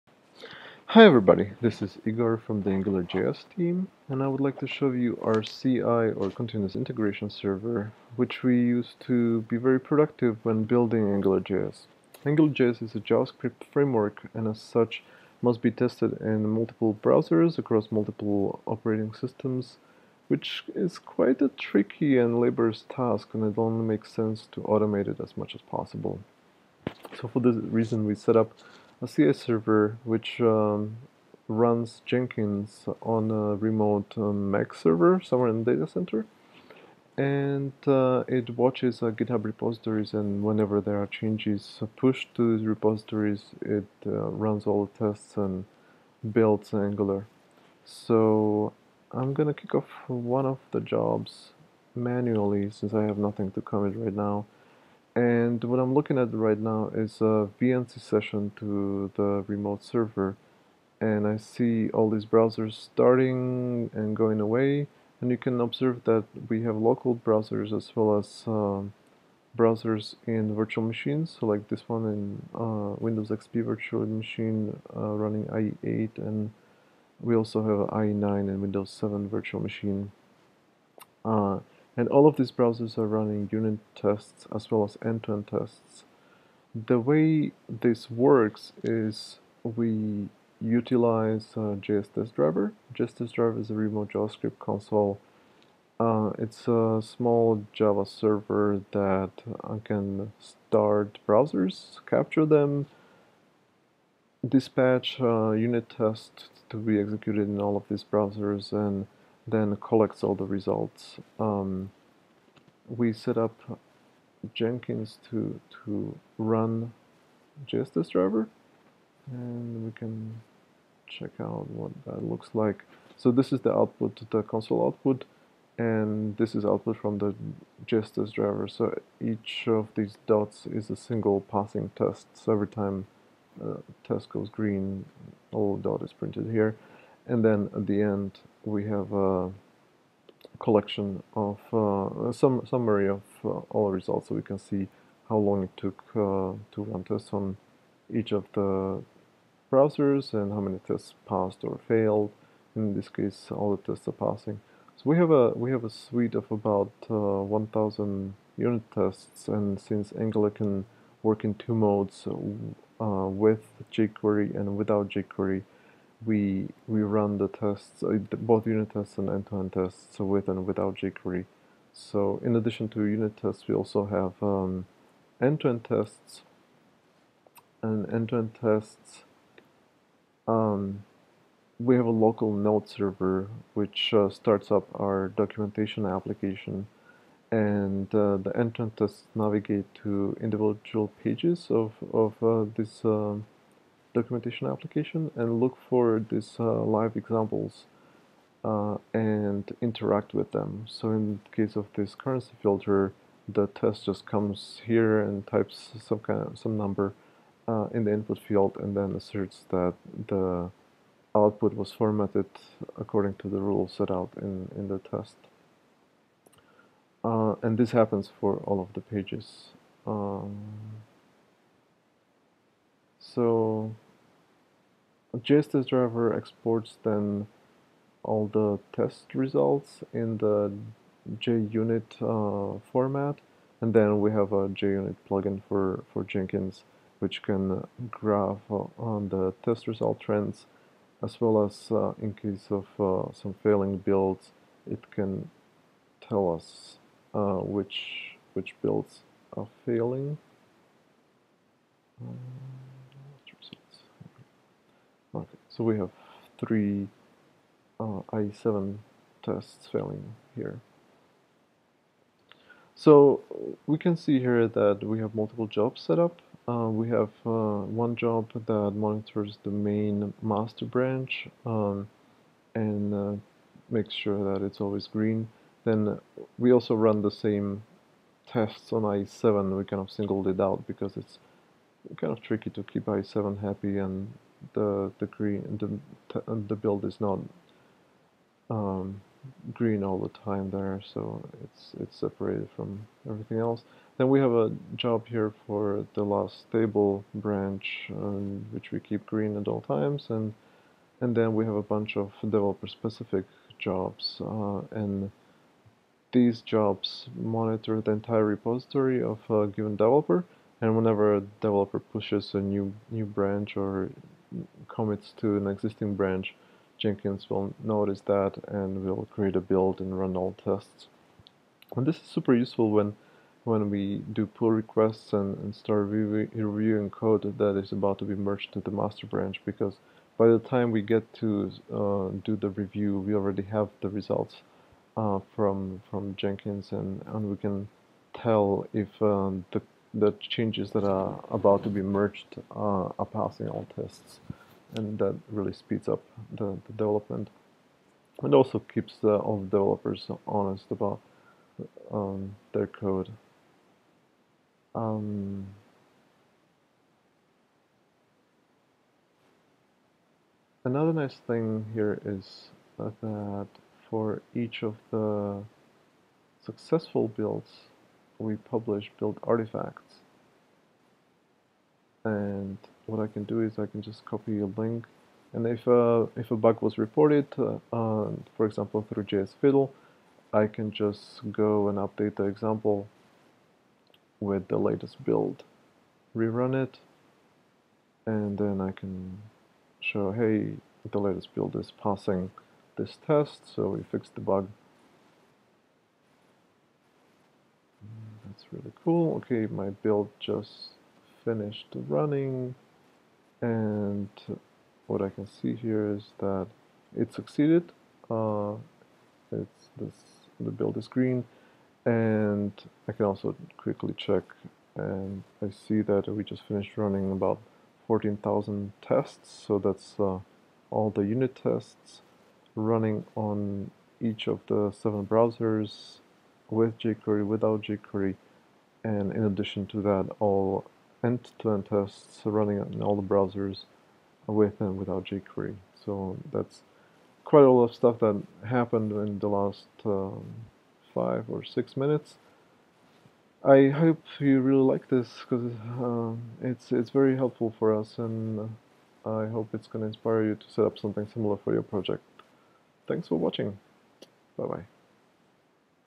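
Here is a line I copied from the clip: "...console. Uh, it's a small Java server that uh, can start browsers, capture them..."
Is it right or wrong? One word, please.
right.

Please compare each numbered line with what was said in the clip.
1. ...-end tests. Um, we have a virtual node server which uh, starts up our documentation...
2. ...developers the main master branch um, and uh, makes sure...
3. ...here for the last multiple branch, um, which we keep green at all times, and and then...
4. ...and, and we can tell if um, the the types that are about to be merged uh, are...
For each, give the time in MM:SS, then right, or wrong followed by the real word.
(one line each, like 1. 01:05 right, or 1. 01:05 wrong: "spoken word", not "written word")
1. 02:58 wrong: "local", not "virtual"
2. 04:28 wrong: "monitors", not "developers"
3. 04:55 wrong: "stable", not "multiple"
4. 05:36 wrong: "changes", not "types".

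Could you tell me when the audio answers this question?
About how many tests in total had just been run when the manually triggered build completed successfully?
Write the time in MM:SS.
06:58.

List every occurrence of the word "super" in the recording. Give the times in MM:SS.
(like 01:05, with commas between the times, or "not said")
05:22.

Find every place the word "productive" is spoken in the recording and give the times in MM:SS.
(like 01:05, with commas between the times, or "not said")
00:09.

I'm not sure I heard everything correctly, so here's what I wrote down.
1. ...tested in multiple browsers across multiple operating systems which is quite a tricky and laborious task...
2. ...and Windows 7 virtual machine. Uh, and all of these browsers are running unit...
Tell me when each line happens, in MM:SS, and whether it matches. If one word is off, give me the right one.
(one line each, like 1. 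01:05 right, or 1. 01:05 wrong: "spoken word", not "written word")
1. 00:15 right
2. 01:18 right.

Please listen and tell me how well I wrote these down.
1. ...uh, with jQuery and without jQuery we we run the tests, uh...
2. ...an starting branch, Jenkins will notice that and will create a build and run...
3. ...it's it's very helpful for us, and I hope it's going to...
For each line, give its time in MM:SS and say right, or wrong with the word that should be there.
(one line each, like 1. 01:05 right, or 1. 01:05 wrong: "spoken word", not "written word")
1. 02:42 right
2. 05:15 wrong: "existing", not "starting"
3. 07:26 right.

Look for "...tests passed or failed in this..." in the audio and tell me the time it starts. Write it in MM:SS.
02:30.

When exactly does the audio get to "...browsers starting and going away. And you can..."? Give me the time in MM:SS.
01:02.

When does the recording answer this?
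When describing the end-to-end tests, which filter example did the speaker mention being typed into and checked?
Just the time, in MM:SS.
03:22.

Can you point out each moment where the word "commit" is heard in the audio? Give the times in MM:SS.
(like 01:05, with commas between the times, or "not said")
00:53, 05:14.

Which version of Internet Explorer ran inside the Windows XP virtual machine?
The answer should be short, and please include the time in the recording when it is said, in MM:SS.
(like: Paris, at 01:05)
IE8, at 01:15.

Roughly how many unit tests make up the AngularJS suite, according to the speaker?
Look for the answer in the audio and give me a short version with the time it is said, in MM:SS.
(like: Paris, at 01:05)
1000, at 02:37.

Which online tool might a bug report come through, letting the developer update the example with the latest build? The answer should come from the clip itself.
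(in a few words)
JS Fiddle.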